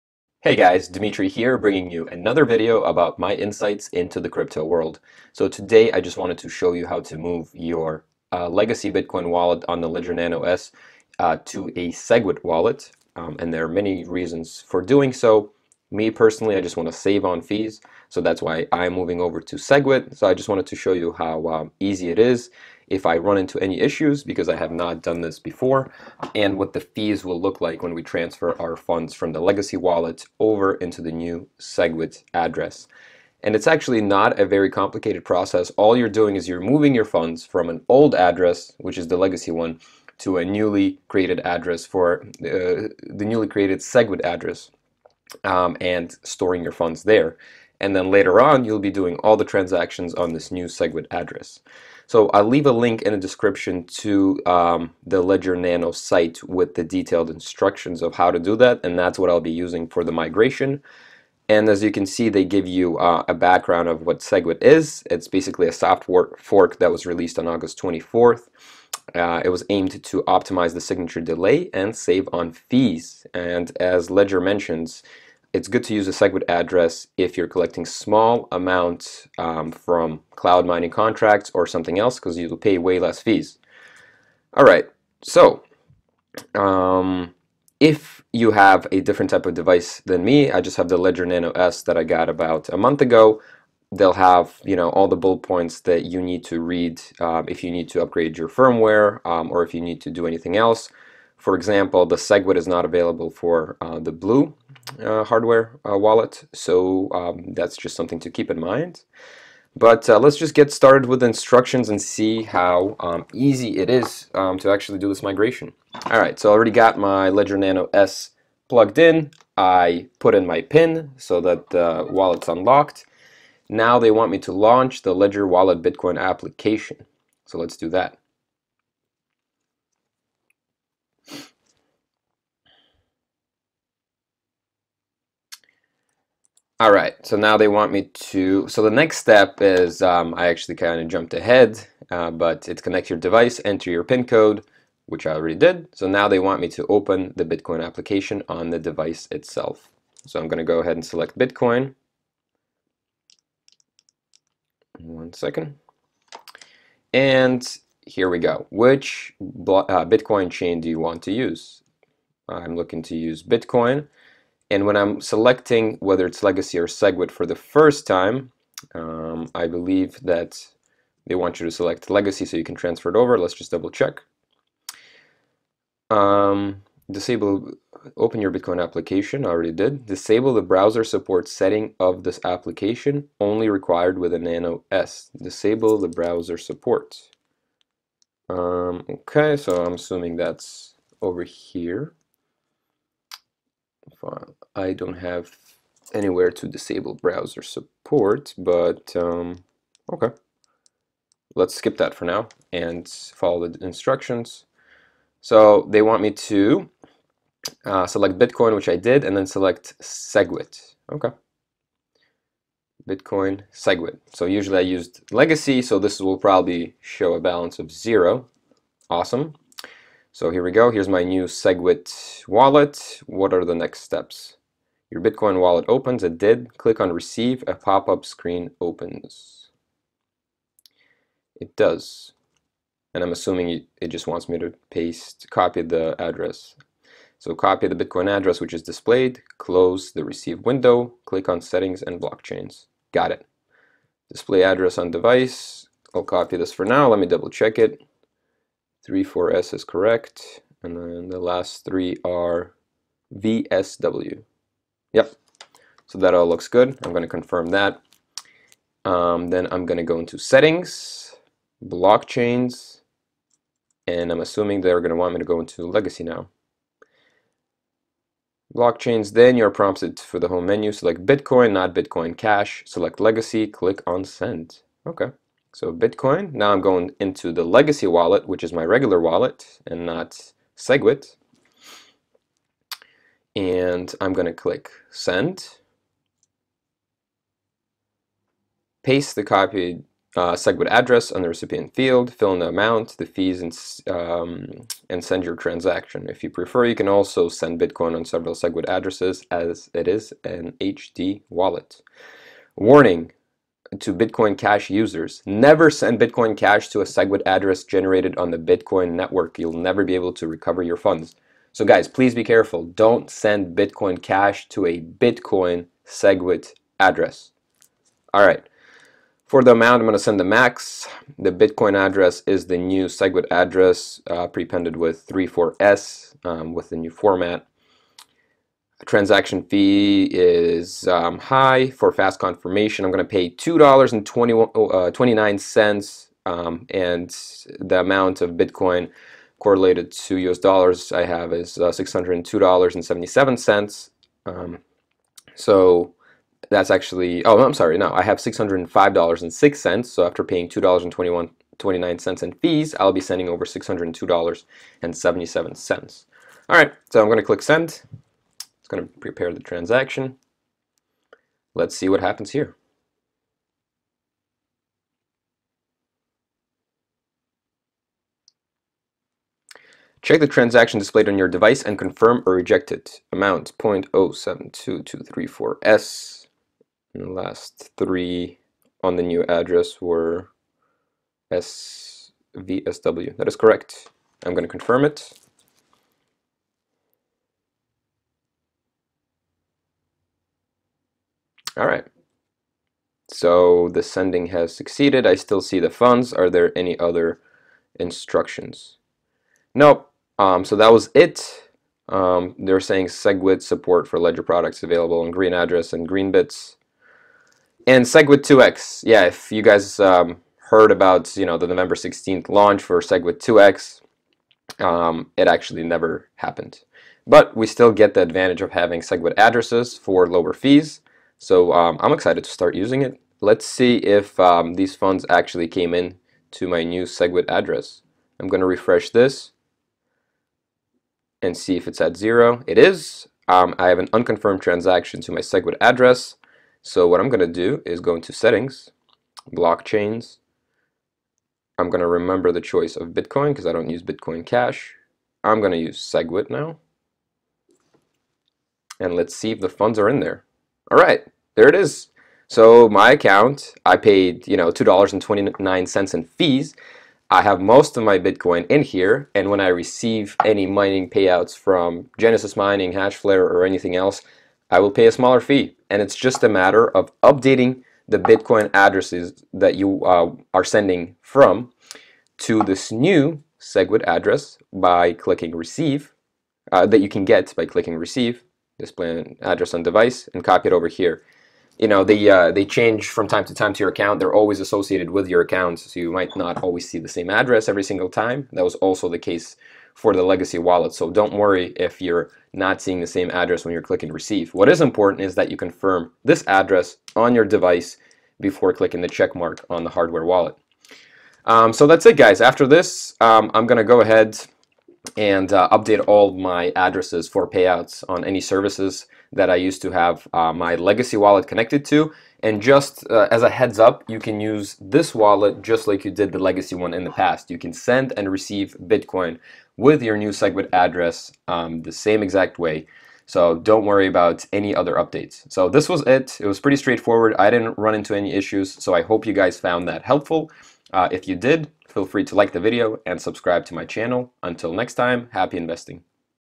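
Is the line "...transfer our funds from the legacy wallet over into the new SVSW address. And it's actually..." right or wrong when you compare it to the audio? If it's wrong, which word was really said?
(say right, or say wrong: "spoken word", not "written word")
wrong: "SegWit", not "SVSW".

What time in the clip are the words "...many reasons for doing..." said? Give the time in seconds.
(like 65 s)
13 s.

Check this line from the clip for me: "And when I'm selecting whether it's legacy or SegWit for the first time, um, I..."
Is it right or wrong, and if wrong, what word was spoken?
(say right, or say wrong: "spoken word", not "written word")
right.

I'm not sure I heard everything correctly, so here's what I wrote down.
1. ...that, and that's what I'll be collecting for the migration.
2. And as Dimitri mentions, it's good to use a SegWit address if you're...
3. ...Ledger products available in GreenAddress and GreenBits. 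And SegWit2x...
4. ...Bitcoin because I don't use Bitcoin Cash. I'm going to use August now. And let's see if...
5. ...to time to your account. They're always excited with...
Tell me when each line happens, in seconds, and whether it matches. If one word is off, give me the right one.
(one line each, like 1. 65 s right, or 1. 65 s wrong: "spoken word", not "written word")
1. 58 s wrong: "using", not "collecting"
2. 73 s wrong: "Ledger", not "Dimitri"
3. 404 s right
4. 443 s wrong: "SegWit", not "August"
5. 483 s wrong: "associated", not "excited".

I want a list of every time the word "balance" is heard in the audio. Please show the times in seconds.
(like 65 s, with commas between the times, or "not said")
217 s.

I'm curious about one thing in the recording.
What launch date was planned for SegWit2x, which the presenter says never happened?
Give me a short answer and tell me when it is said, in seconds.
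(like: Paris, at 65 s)
November 16th, at 411 s.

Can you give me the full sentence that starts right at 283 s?
And I'm going to click Send.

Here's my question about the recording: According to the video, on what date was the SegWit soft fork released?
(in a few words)
August 24th.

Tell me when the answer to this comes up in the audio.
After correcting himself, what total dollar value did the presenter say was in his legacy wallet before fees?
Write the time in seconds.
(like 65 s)
348 s.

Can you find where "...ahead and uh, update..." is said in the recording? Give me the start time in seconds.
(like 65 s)
504 s.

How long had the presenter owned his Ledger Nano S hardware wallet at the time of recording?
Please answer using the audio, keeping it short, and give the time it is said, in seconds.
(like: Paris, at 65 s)
About a month, at 92 s.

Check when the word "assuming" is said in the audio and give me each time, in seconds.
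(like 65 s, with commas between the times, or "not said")
189 s, 233 s, 264 s.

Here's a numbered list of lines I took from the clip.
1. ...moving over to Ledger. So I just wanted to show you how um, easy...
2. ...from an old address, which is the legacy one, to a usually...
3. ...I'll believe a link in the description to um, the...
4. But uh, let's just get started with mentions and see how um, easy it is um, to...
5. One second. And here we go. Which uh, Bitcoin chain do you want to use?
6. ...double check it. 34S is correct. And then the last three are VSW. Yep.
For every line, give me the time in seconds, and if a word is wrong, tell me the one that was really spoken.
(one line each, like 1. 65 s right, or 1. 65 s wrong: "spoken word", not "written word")
1. 18 s wrong: "SegWit", not "Ledger"
2. 37 s wrong: "newly", not "usually"
3. 52 s wrong: "leave", not "believe"
4. 109 s wrong: "instructions", not "mentions"
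5. 155 s right
6. 247 s right.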